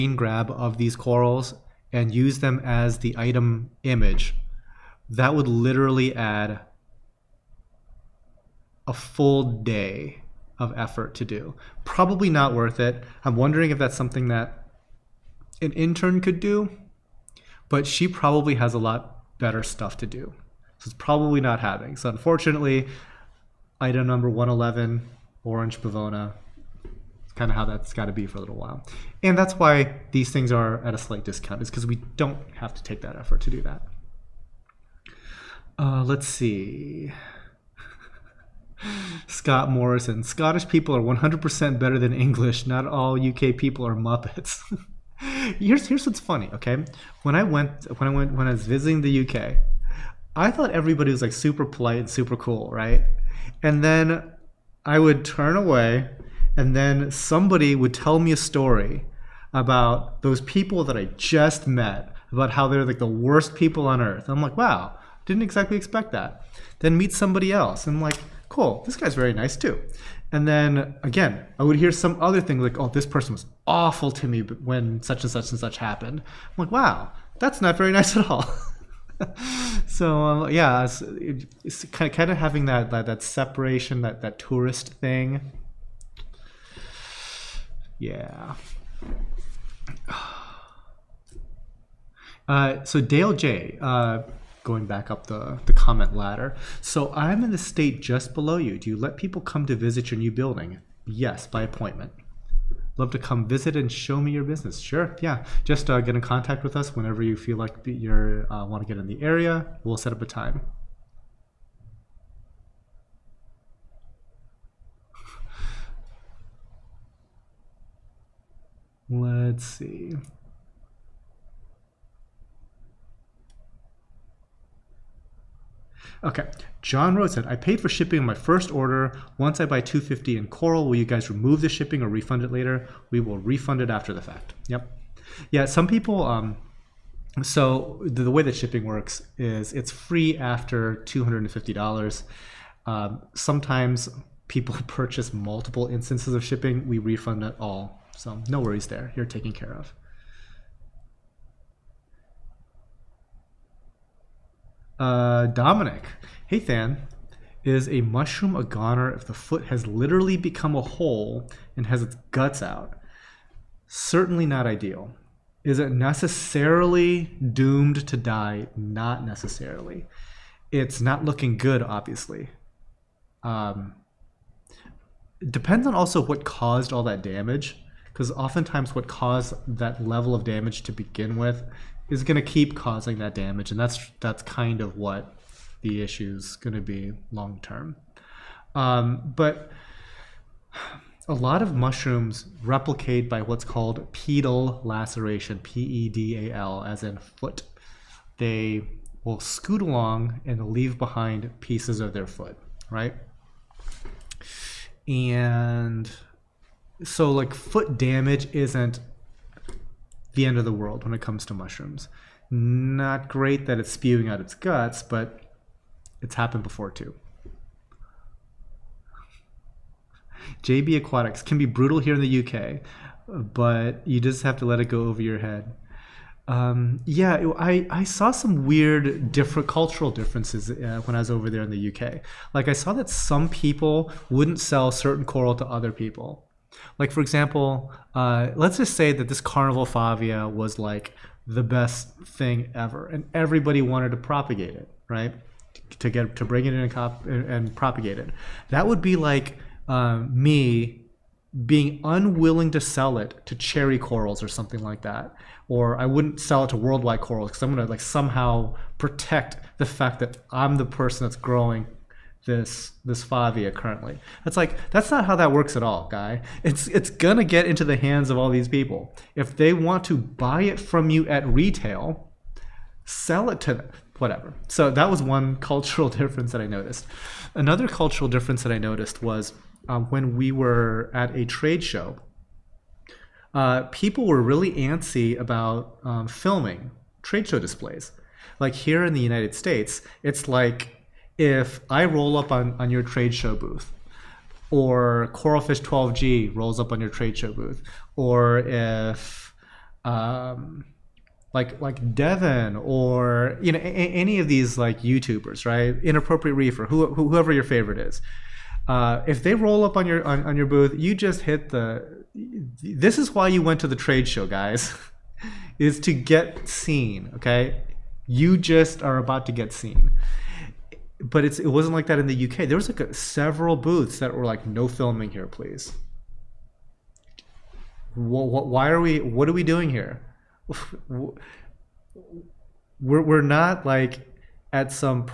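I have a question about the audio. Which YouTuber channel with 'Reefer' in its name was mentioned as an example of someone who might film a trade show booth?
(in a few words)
Inappropriate Reefer.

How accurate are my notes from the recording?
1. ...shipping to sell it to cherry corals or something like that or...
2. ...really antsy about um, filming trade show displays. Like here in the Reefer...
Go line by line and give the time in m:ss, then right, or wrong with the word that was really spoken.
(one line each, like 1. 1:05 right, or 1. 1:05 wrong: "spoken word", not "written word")
1. 4:12 wrong: "unwilling", not "shipping"
2. 4:44 wrong: "United", not "Reefer".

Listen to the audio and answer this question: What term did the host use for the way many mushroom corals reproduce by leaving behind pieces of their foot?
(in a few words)
pedal laceration.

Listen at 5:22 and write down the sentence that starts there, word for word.
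There was like a, several booths that were like, "No filming here, please." What, what, why are we?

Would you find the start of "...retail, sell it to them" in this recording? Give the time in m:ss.
4:31.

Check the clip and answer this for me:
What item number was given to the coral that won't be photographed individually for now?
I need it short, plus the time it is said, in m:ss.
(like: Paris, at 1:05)
111, at 0:24.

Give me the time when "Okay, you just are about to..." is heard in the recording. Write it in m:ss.
5:17.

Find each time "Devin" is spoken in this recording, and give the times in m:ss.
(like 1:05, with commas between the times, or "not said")
5:02.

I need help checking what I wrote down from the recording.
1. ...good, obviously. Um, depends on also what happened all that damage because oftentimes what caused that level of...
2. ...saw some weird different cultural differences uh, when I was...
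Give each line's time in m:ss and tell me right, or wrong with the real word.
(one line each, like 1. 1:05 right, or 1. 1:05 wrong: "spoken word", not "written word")
1. 2:51 wrong: "caused", not "happened"
2. 3:48 right.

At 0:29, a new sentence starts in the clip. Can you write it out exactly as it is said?
And that's why these things are at a slight discount, is because we don't have to take that effort to do that.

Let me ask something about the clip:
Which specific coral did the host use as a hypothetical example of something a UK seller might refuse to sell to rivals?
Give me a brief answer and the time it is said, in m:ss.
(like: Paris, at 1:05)
carnival favia, at 3:59.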